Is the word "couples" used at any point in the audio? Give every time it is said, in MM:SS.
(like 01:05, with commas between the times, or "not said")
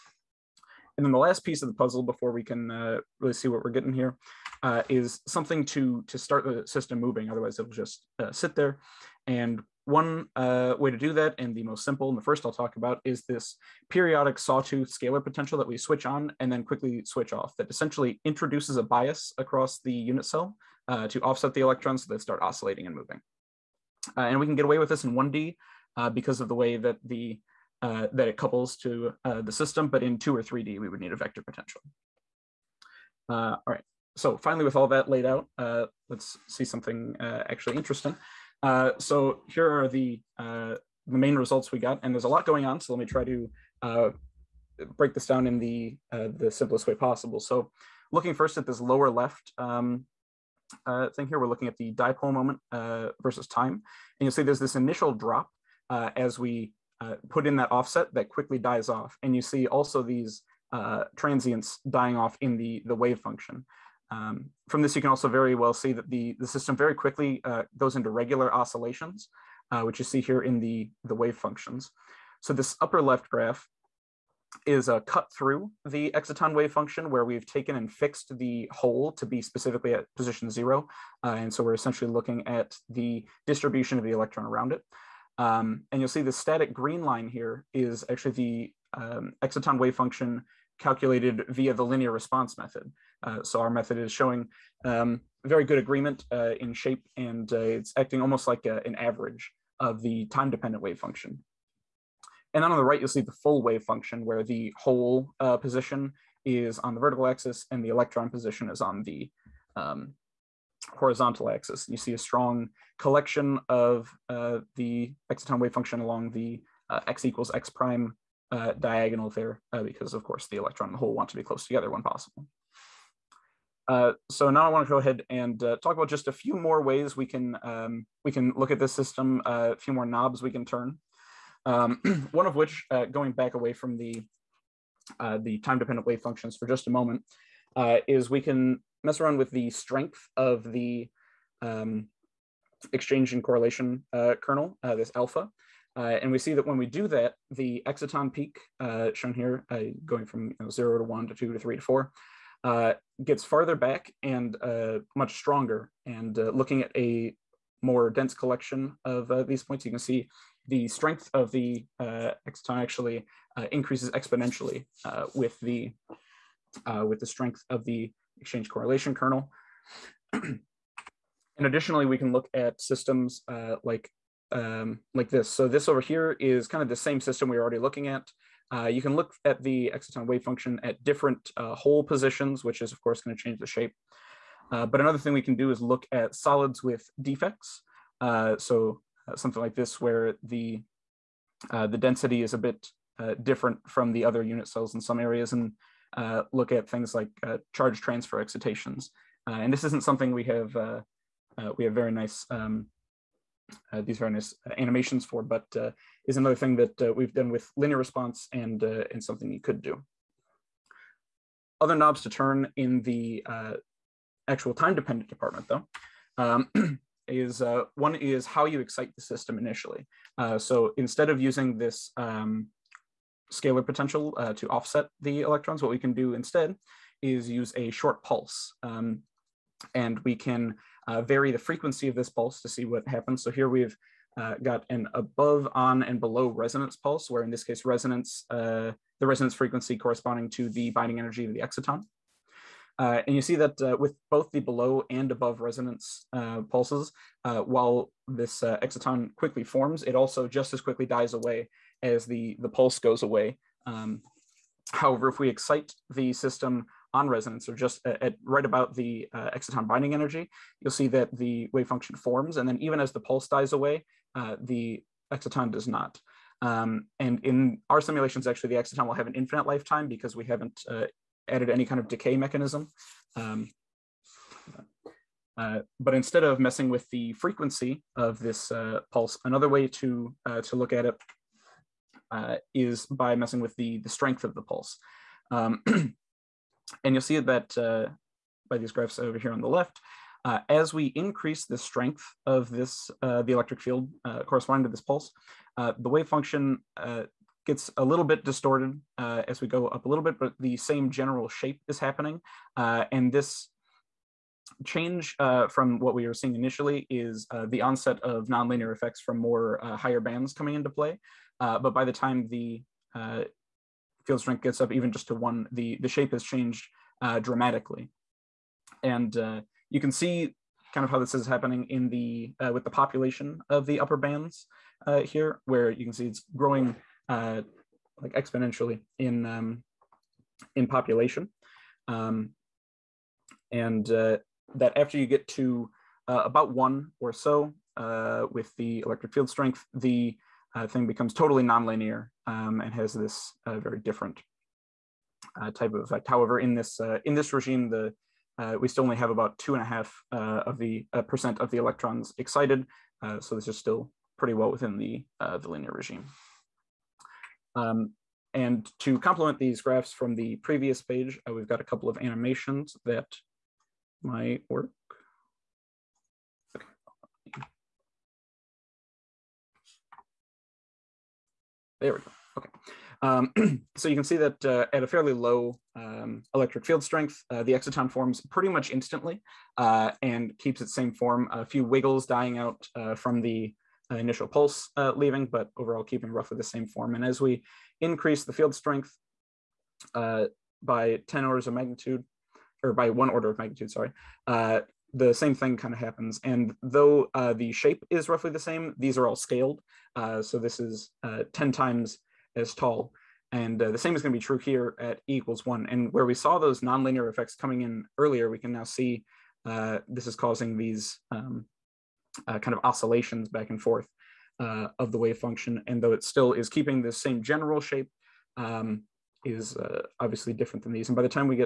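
00:28, 06:01.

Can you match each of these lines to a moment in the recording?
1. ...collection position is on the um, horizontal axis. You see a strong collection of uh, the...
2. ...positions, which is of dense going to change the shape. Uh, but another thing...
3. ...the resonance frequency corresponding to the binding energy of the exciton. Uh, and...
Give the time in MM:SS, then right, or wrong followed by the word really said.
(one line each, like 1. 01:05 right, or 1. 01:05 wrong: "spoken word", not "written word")
1. 01:47 wrong: "electron", not "collection"
2. 03:02 wrong: "course", not "dense"
3. 03:59 right.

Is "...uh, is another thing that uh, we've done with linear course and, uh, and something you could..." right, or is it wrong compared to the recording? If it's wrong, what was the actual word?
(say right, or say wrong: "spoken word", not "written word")
wrong: "response", not "course".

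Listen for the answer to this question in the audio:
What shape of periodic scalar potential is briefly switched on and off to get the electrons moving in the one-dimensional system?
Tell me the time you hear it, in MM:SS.
00:14.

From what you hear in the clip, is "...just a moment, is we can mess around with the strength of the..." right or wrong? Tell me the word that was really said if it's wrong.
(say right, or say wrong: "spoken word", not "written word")
right.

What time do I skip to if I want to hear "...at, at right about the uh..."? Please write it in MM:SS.
04:18.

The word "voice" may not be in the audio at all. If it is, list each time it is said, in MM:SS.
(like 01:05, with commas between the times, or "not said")
not said.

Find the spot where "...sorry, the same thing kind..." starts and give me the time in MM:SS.
06:33.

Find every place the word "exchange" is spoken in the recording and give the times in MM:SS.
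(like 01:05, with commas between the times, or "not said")
02:22, 02:48.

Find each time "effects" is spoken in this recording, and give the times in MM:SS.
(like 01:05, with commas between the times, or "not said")
05:08, 05:46, 06:47.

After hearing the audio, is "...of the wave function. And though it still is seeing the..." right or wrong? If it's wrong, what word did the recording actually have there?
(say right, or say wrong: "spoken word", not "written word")
wrong: "keeping", not "seeing".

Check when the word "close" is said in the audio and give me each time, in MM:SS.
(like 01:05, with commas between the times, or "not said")
02:01.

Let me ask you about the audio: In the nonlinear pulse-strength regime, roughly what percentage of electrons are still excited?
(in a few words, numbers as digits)
2.5 percent.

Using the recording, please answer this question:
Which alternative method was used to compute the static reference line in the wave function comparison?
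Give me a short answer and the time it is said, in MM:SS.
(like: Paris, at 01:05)
Linear response method, at 01:31.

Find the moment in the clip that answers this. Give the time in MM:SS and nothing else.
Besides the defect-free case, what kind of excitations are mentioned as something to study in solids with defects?
03:17.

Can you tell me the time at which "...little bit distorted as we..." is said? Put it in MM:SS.
04:58.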